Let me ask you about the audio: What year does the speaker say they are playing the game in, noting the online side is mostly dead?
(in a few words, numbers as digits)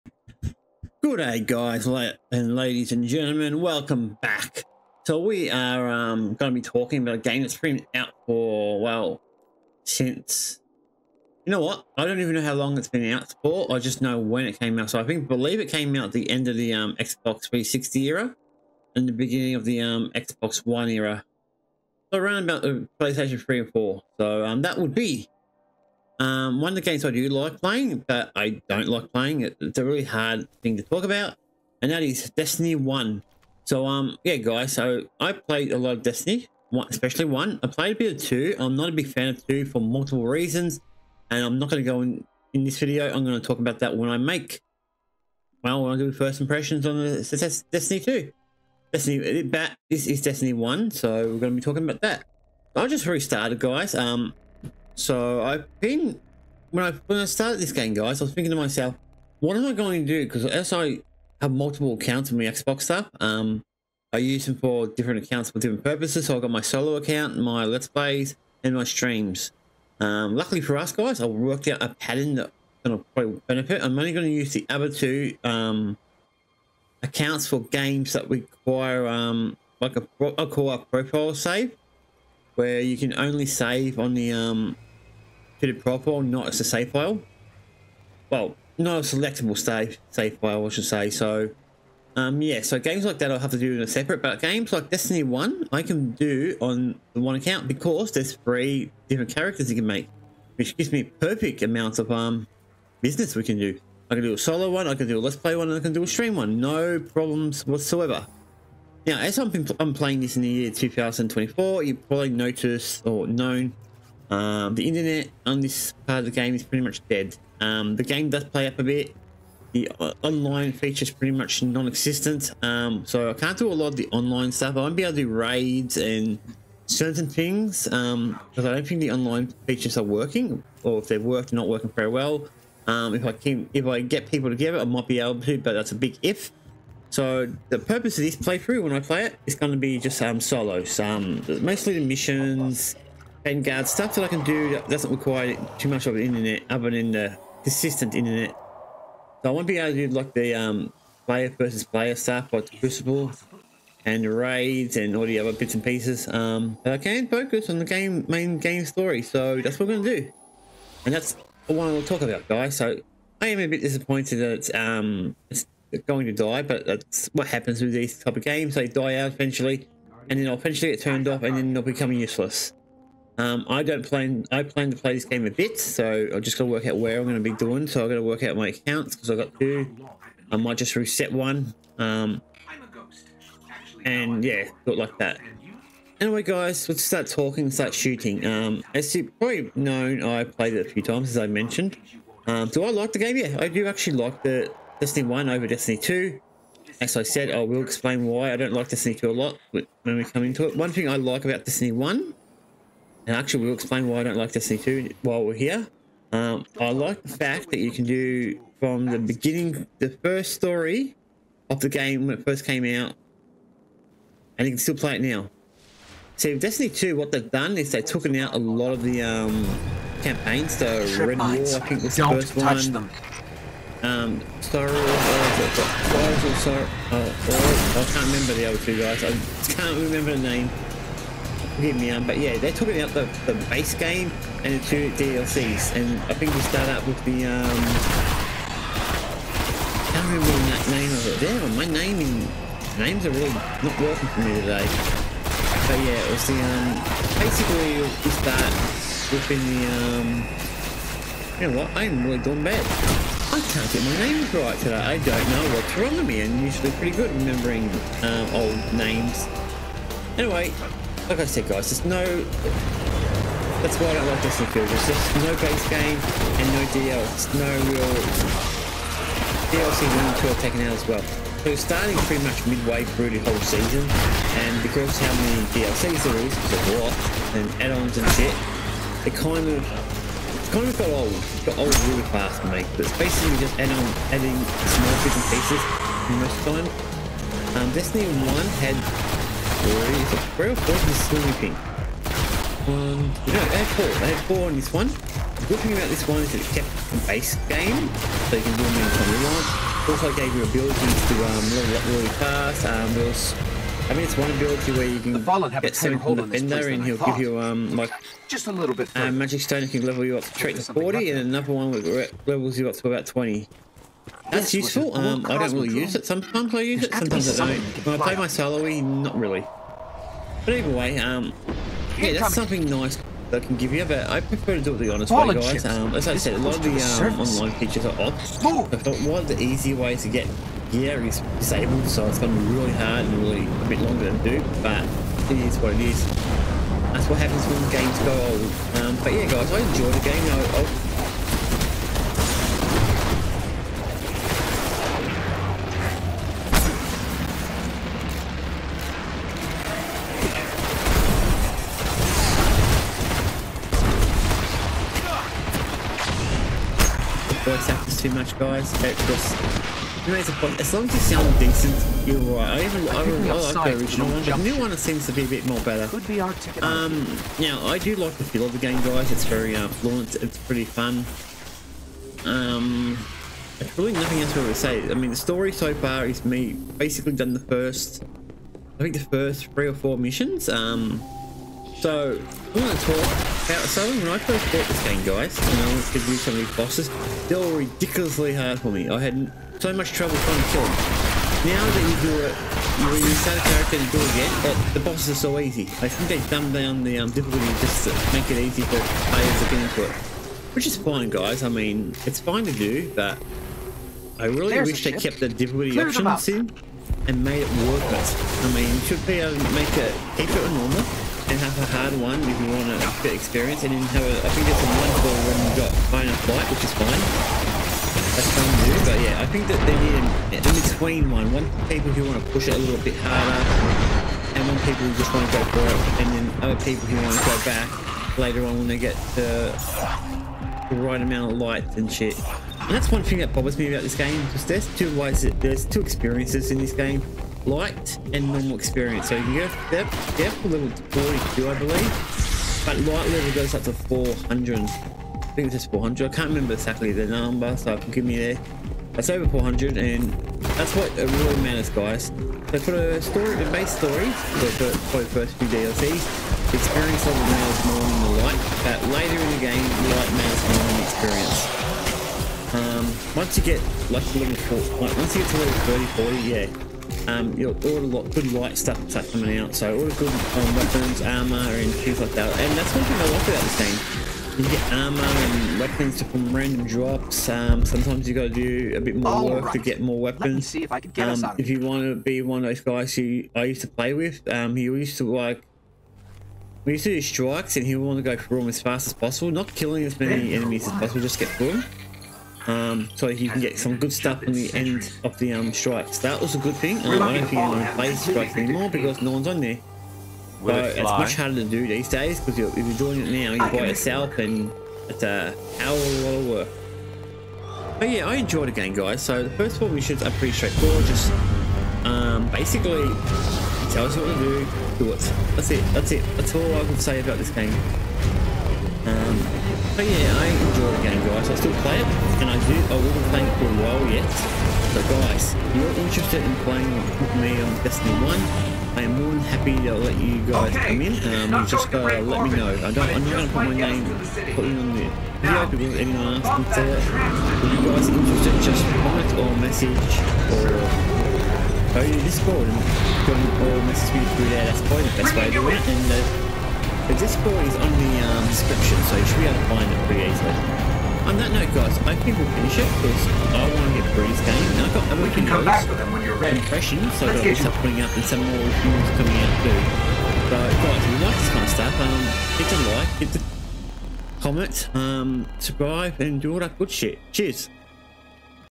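2024.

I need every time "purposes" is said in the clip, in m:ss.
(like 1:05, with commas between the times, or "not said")
1:05, 2:17.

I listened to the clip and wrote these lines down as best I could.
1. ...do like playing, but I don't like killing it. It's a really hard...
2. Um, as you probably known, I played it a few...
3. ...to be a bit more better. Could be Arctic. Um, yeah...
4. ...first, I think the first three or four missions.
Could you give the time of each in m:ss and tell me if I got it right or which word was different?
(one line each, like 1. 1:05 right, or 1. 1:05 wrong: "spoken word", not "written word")
1. 0:27 wrong: "playing", not "killing"
2. 3:08 right
3. 6:05 right
4. 6:17 right.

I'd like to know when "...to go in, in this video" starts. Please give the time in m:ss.
0:41.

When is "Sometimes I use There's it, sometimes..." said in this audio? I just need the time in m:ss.
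5:16.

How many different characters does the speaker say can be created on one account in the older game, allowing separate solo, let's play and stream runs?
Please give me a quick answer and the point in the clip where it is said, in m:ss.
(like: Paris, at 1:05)
3, at 1:38.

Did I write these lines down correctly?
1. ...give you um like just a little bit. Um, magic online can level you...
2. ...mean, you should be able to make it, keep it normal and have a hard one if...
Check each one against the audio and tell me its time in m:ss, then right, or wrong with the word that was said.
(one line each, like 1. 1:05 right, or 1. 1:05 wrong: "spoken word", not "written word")
1. 5:07 wrong: "stone", not "online"
2. 6:48 right.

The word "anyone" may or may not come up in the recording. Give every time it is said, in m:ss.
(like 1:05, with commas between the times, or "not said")
8:17, 8:55.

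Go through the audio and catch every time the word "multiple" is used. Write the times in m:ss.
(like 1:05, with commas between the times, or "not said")
0:39, 1:01.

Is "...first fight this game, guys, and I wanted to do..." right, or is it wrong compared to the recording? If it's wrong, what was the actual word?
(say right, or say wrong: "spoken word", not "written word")
wrong: "bought", not "fight".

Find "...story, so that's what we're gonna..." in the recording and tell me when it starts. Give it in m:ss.
2:38.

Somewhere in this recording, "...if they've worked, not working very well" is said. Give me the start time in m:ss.
2:10.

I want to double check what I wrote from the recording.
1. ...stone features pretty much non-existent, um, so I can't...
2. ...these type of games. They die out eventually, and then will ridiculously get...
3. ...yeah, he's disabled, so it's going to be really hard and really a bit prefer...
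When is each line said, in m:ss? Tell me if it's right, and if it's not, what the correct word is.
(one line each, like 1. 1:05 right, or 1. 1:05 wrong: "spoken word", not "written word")
1. 2:00 wrong: "online", not "stone"
2. 2:47 wrong: "eventually", not "ridiculously"
3. 5:30 wrong: "longer", not "prefer".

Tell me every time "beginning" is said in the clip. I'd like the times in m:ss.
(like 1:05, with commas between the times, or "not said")
0:19, 3:29.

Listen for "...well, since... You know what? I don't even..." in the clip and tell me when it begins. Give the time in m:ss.
0:08.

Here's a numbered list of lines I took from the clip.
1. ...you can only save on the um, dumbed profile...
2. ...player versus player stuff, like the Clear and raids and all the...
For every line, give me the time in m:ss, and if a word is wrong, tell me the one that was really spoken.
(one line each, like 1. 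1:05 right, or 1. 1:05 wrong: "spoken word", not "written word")
1. 1:22 wrong: "fitted", not "dumbed"
2. 2:31 wrong: "Crucible", not "Clear".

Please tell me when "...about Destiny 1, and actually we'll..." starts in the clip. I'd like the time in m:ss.
3:21.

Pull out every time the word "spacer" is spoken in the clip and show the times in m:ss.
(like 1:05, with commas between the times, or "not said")
not said.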